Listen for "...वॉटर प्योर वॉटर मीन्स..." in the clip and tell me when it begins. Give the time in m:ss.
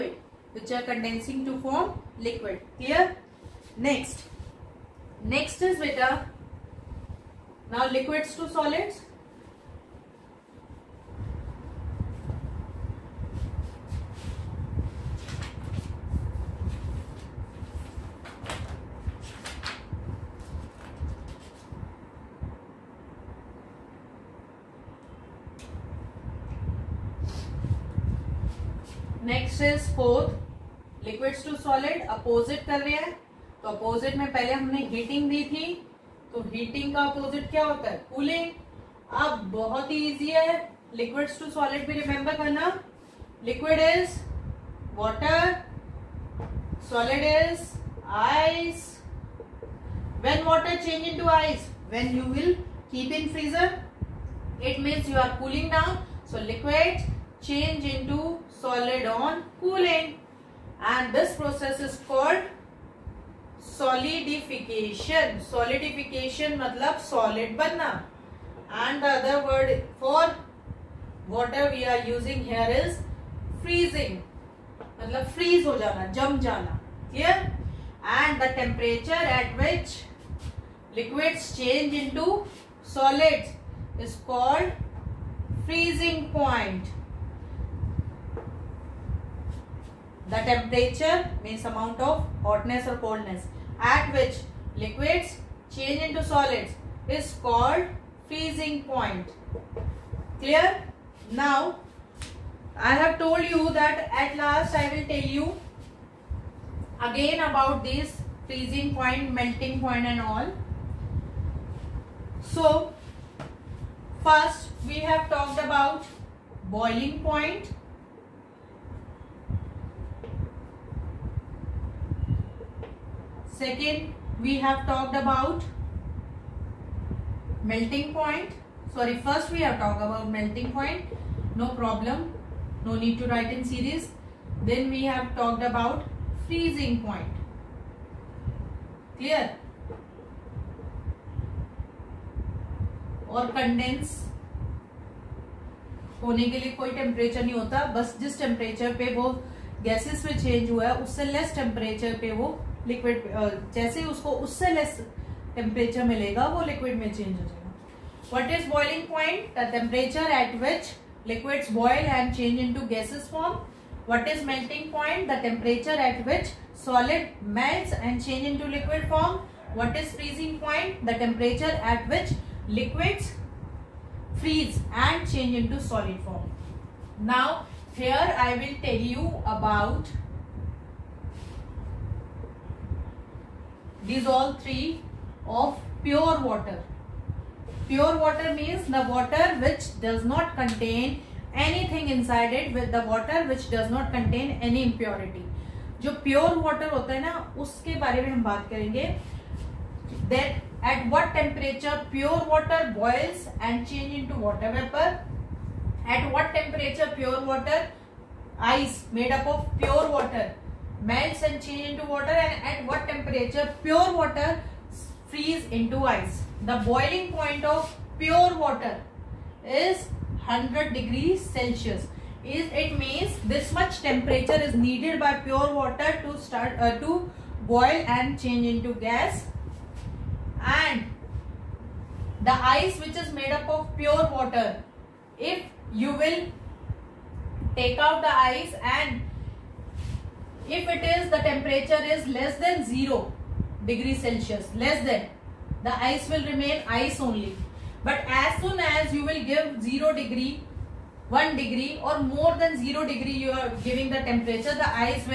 3:06.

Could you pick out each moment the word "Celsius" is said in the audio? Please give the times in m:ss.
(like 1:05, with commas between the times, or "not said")
3:41, 4:04.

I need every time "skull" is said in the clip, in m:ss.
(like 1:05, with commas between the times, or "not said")
not said.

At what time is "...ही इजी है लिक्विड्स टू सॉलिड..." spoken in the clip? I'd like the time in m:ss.
0:39.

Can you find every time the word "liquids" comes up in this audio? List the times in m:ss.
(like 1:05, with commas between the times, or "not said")
0:02, 0:07, 1:20, 1:34.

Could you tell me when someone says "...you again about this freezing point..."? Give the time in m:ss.
1:45.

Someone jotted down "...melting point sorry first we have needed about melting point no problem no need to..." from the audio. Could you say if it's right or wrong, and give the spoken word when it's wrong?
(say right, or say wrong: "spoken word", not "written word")
wrong: "talked", not "needed".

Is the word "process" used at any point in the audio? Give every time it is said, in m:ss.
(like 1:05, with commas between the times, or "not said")
1:01.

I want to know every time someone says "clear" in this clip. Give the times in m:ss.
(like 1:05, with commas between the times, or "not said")
0:02, 1:17, 1:40, 2:19.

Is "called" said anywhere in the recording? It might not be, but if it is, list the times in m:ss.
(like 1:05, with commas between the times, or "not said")
1:02, 1:24, 1:37.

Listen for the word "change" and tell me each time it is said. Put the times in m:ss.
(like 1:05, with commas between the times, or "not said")
1:21, 1:35, 3:31, 3:48.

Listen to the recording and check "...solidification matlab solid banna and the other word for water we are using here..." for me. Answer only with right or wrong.
right.